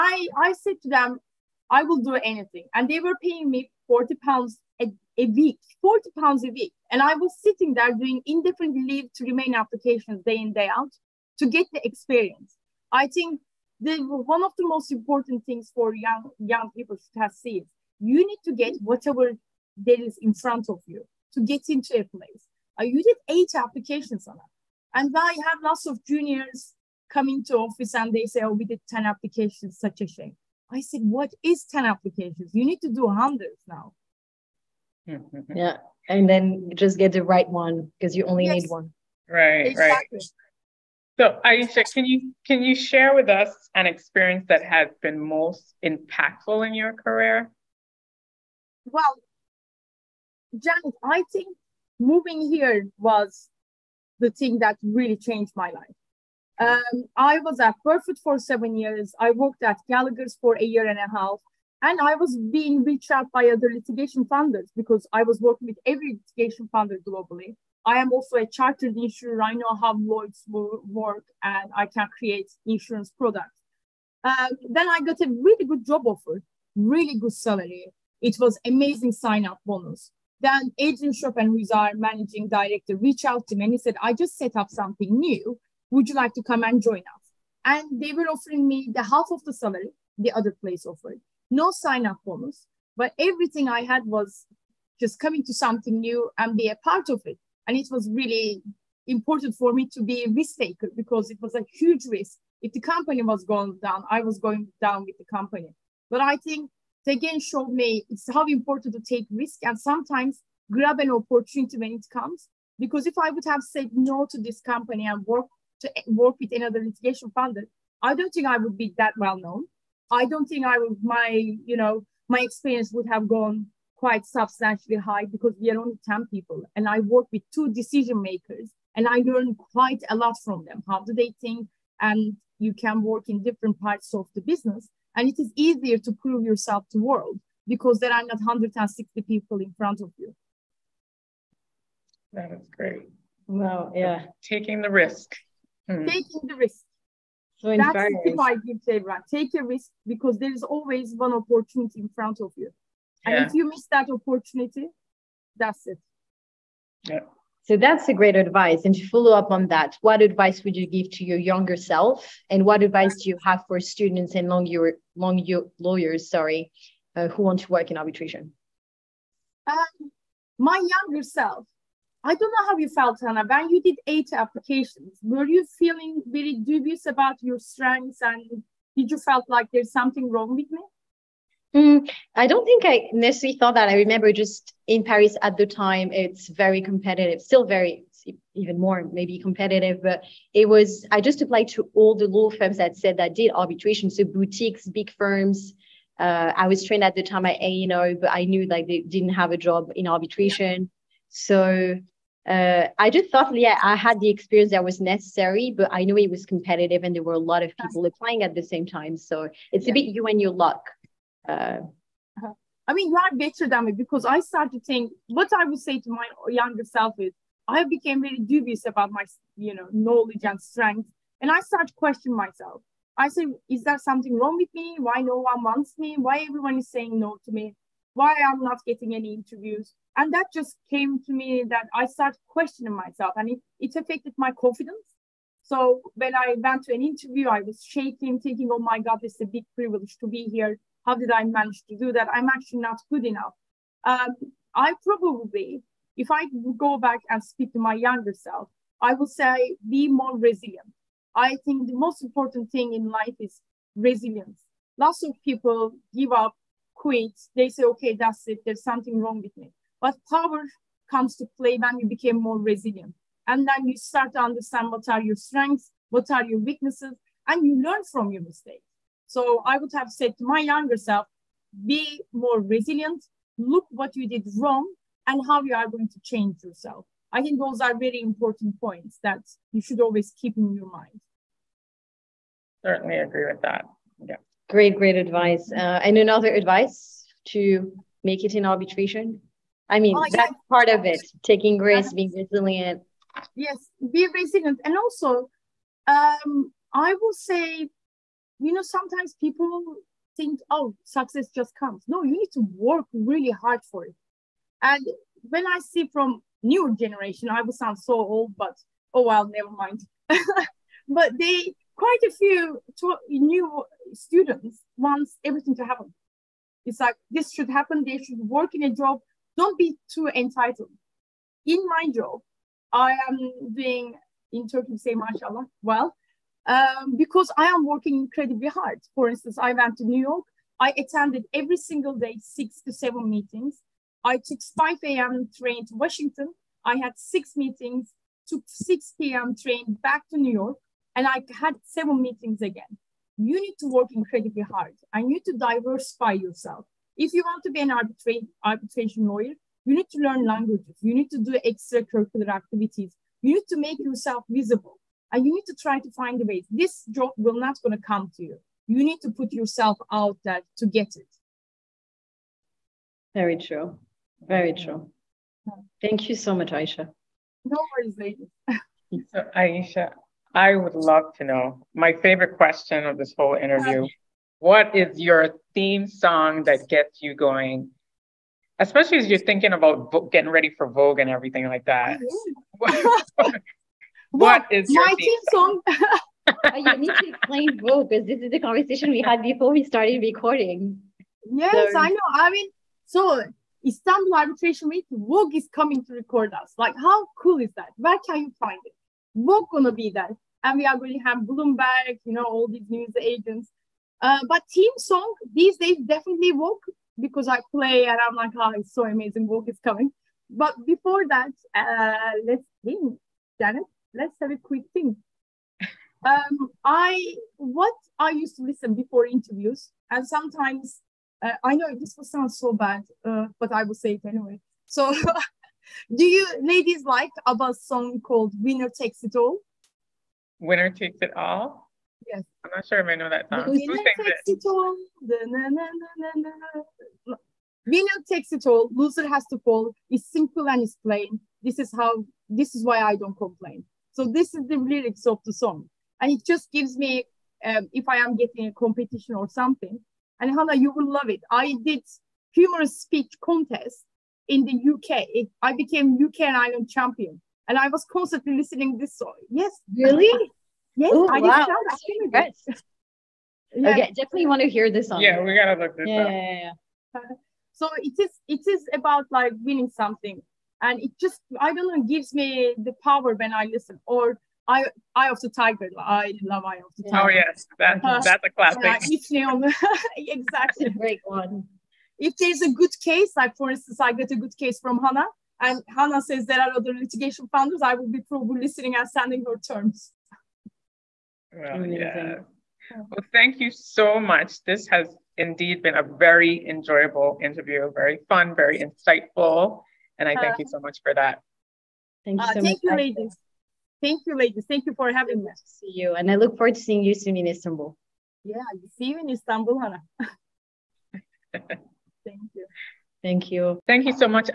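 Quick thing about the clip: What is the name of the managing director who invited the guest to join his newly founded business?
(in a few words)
Adrian Chopin.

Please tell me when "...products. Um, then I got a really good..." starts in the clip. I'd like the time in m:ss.
1:13.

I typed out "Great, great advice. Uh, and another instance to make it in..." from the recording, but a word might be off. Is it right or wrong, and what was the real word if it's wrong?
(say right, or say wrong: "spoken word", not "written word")
wrong: "advice", not "instance".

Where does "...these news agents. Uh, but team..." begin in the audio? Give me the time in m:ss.
6:42.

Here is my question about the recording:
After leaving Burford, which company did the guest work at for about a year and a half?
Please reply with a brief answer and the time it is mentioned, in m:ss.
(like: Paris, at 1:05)
Gallagher's, at 0:59.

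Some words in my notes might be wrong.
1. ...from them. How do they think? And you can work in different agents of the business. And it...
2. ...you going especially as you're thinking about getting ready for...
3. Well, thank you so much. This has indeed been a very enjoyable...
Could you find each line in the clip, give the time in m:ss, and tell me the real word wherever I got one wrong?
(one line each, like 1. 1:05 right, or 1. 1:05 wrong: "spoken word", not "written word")
1. 2:10 wrong: "parts", not "agents"
2. 6:17 right
3. 8:12 right.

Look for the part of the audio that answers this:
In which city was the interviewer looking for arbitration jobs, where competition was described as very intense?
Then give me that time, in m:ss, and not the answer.
3:05.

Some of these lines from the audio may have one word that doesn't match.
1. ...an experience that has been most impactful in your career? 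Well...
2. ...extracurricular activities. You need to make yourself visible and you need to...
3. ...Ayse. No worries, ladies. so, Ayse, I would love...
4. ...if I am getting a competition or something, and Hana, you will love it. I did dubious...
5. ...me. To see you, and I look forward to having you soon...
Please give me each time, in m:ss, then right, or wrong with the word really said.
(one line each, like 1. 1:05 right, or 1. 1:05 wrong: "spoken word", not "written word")
1. 0:43 right
2. 5:51 right
3. 6:06 right
4. 7:27 wrong: "humorous", not "dubious"
5. 8:25 wrong: "seeing", not "having".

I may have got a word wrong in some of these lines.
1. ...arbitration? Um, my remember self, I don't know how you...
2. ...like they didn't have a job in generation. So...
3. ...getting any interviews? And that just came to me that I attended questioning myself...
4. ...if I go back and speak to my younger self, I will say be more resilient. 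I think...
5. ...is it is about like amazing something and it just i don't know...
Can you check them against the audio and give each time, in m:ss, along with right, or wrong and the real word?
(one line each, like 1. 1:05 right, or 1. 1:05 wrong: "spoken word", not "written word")
1. 2:47 wrong: "younger", not "remember"
2. 3:18 wrong: "arbitration", not "generation"
3. 3:48 wrong: "started", not "attended"
4. 4:06 right
5. 7:48 wrong: "winning", not "amazing".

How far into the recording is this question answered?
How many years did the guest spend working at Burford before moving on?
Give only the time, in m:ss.
0:58.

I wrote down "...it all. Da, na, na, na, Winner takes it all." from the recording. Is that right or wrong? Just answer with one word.
right.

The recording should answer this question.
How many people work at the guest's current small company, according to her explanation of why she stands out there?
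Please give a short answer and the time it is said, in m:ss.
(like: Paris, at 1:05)
10, at 2:06.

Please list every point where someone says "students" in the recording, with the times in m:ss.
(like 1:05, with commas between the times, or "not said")
2:43, 5:14.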